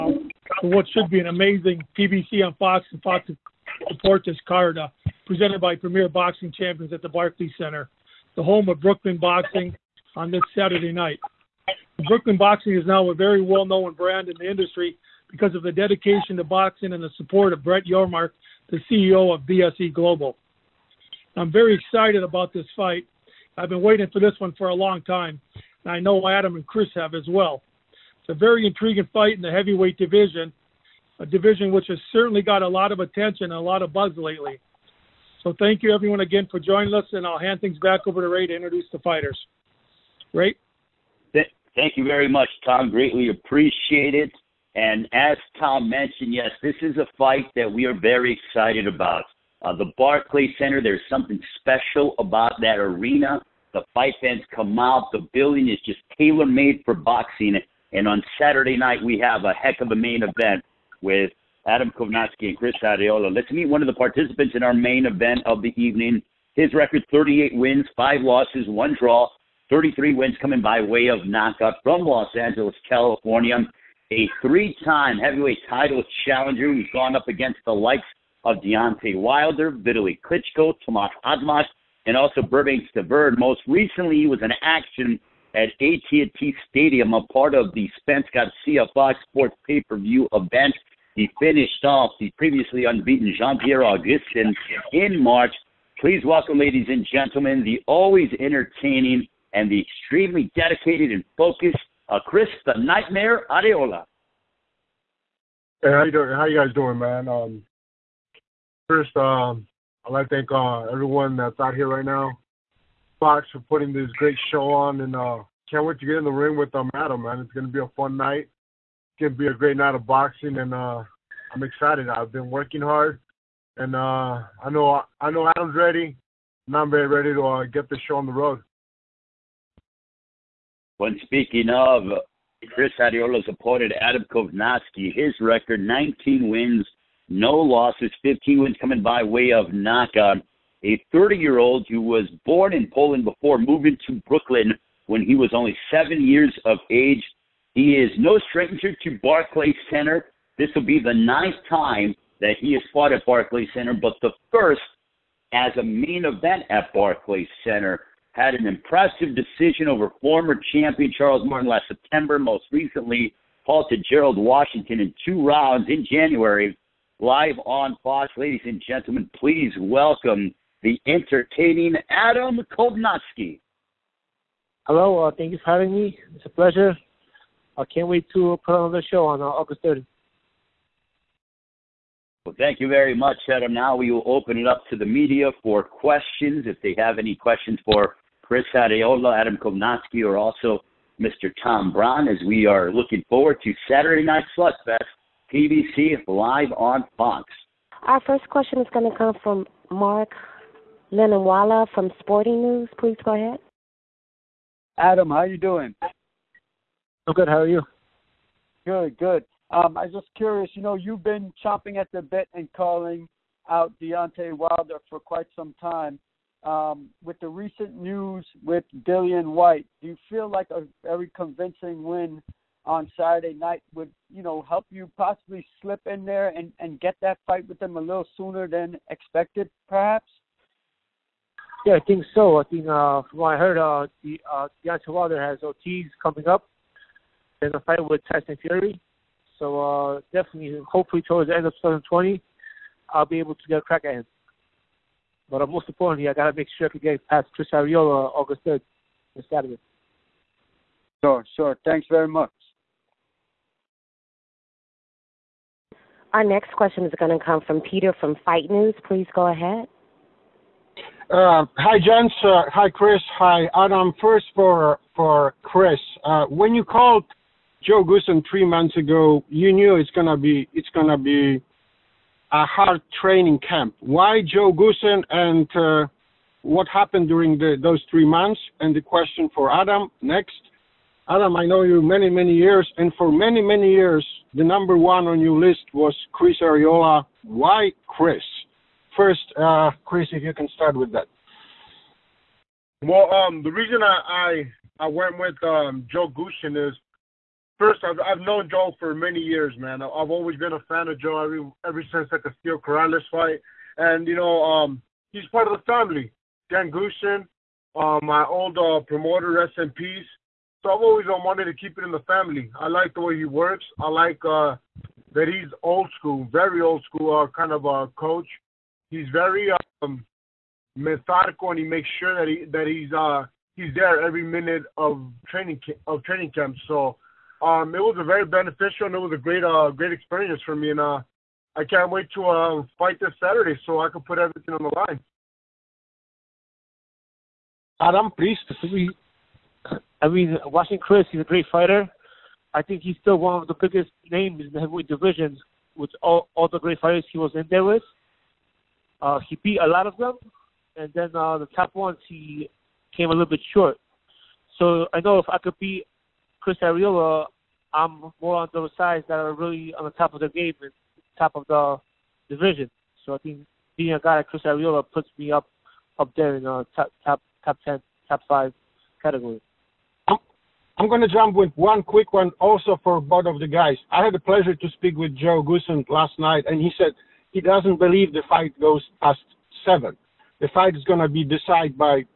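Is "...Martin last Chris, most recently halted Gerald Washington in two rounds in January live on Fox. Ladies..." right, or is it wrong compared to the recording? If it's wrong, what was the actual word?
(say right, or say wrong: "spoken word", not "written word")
wrong: "September", not "Chris".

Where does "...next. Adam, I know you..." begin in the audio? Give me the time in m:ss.
4:40.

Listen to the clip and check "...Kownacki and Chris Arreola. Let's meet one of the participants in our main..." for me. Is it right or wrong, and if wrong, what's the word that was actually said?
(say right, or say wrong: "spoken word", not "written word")
right.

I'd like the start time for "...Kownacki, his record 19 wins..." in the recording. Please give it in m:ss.
2:14.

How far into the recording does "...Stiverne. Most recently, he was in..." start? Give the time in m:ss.
1:22.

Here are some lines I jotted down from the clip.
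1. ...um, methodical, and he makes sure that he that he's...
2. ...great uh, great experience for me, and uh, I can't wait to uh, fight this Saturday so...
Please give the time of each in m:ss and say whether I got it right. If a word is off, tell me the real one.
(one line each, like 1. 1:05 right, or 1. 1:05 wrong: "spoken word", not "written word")
1. 5:20 right
2. 5:29 right.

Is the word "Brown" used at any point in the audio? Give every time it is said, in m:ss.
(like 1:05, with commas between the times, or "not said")
3:11.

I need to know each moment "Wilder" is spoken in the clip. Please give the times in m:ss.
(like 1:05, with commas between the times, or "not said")
1:19, 3:34, 3:55.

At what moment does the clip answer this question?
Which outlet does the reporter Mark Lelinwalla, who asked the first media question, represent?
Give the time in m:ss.
3:22.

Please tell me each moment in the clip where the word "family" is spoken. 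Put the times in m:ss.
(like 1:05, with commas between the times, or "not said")
5:05, 5:12.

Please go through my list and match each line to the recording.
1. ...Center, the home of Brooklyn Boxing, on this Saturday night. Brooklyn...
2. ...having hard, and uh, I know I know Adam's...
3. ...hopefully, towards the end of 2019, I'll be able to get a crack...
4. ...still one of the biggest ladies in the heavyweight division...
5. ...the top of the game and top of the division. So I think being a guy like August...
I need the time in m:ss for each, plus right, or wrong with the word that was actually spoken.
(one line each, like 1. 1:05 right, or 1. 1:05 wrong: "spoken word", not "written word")
1. 0:07 right
2. 2:02 wrong: "working", not "having"
3. 4:00 wrong: "2020", not "2019"
4. 5:43 wrong: "names", not "ladies"
5. 6:00 wrong: "Chris", not "August".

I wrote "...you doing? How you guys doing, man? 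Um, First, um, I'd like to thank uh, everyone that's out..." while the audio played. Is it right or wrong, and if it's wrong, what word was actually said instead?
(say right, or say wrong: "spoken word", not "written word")
right.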